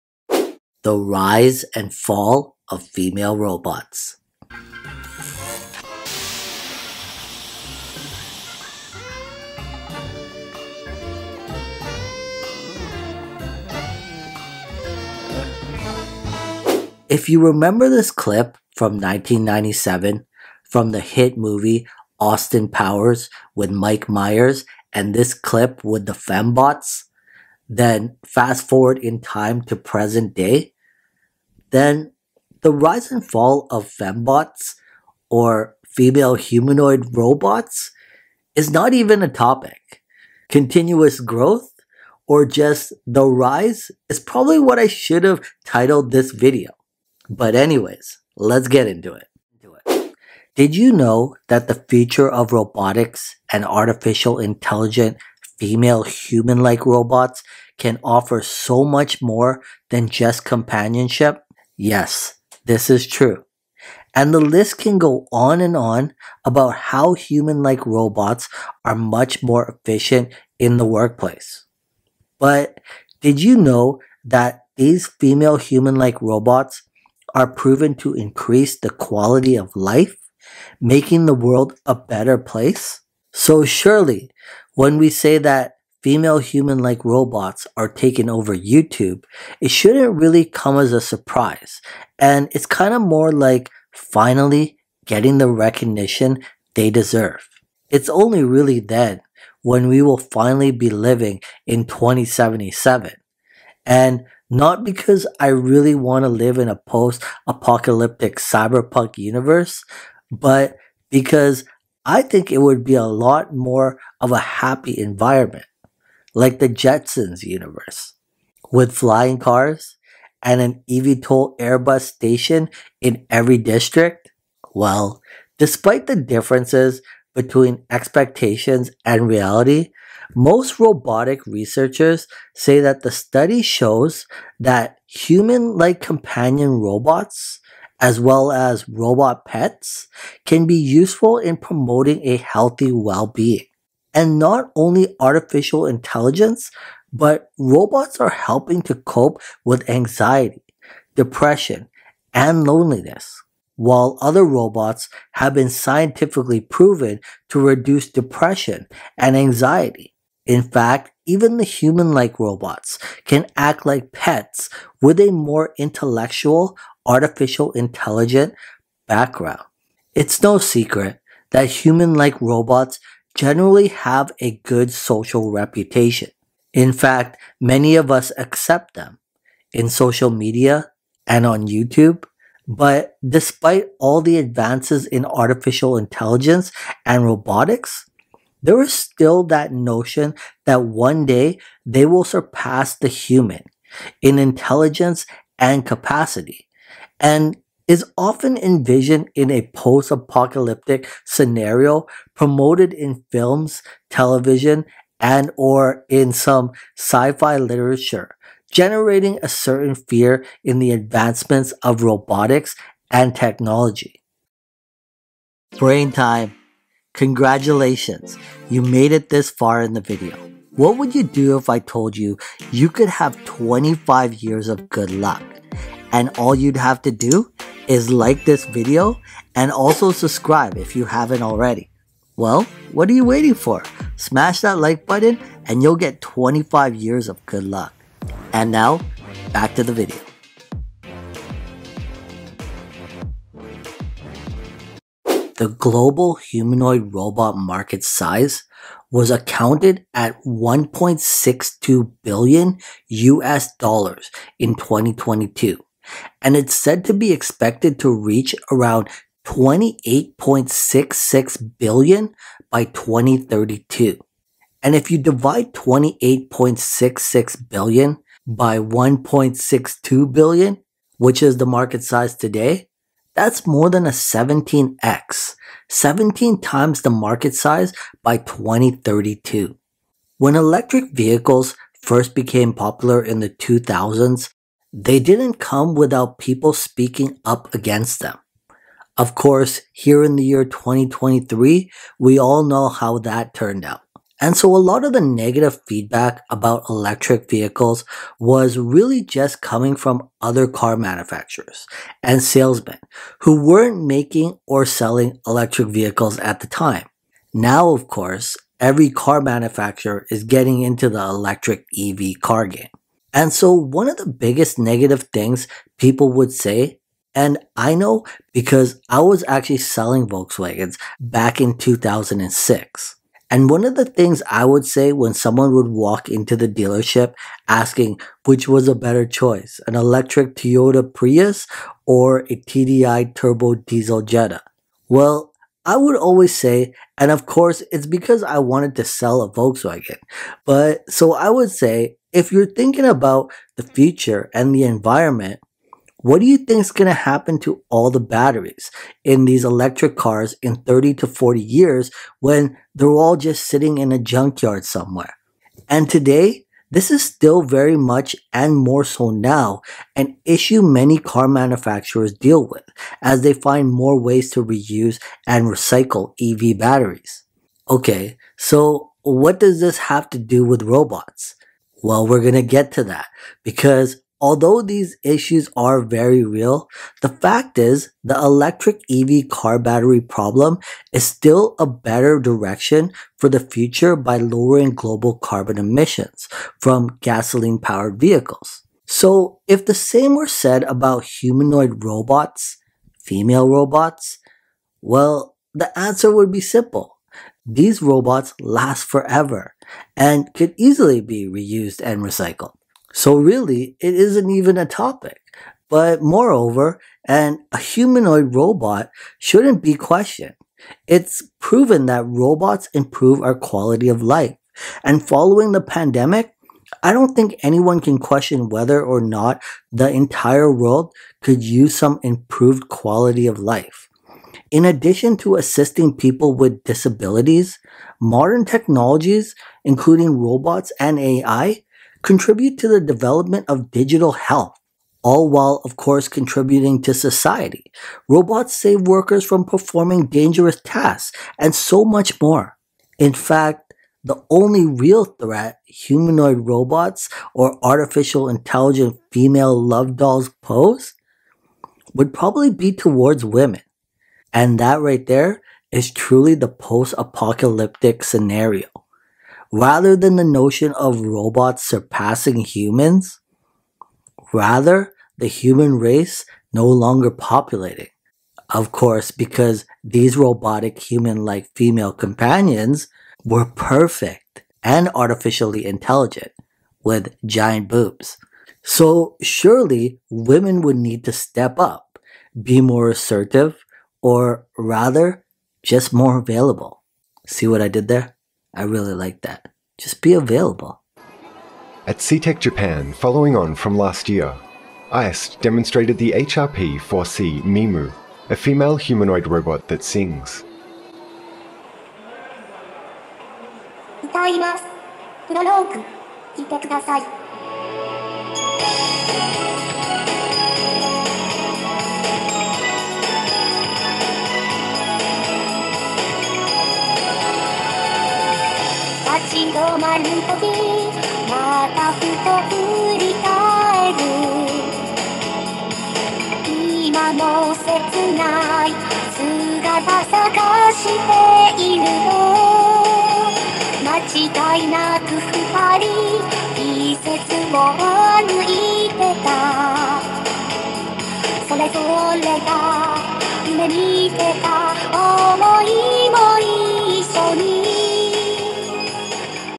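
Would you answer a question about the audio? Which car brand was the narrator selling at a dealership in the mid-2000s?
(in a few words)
Volkswagen.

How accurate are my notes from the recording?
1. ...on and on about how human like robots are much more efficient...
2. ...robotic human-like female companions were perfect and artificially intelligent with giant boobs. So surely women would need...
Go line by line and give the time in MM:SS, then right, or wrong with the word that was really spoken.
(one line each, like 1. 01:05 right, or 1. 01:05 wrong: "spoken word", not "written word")
1. 01:05 right
2. 07:50 right.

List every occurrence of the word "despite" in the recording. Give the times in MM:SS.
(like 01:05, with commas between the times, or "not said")
02:05, 03:03.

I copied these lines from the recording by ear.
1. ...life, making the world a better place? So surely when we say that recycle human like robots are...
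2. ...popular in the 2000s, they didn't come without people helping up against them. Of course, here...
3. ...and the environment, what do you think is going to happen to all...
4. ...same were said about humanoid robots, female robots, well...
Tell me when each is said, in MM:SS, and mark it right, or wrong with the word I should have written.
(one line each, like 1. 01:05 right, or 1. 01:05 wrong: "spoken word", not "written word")
1. 01:19 wrong: "female", not "recycle"
2. 04:42 wrong: "speaking", not "helping"
3. 05:44 right
4. 06:29 right.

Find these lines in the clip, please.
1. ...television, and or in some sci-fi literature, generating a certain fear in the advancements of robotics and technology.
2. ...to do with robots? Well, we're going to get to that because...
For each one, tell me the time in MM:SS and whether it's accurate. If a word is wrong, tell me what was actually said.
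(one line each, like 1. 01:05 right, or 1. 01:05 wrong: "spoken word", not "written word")
1. 03:24 right
2. 06:10 right.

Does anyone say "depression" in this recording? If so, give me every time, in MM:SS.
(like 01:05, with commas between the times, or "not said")
02:31, 02:38.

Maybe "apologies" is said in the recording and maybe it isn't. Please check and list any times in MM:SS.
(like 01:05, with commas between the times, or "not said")
not said.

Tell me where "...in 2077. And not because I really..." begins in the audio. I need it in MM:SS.
01:41.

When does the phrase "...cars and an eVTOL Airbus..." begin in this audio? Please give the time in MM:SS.
01:59.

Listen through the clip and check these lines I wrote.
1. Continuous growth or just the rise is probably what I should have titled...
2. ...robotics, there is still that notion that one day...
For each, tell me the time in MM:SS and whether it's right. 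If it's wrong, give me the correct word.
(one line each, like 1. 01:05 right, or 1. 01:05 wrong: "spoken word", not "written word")
1. 00:40 right
2. 03:07 right.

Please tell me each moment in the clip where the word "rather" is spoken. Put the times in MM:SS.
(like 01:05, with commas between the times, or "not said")
07:39, 07:44, 08:04.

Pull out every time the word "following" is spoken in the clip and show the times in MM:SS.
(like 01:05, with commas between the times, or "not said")
06:55, 08:13.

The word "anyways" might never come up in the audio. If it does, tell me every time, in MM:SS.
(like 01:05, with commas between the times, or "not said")
00:47.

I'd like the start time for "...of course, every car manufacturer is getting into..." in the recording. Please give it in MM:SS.
05:07.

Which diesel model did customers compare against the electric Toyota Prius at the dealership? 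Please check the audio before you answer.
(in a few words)
TDI turbo diesel Jetta.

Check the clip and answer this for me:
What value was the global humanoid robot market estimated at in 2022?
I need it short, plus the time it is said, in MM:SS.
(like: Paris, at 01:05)
1.62 billion US dollars, at 04:10.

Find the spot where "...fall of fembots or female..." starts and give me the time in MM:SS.
00:33.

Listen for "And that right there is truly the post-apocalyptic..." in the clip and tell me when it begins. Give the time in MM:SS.
07:34.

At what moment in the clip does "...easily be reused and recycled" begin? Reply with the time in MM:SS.
06:40.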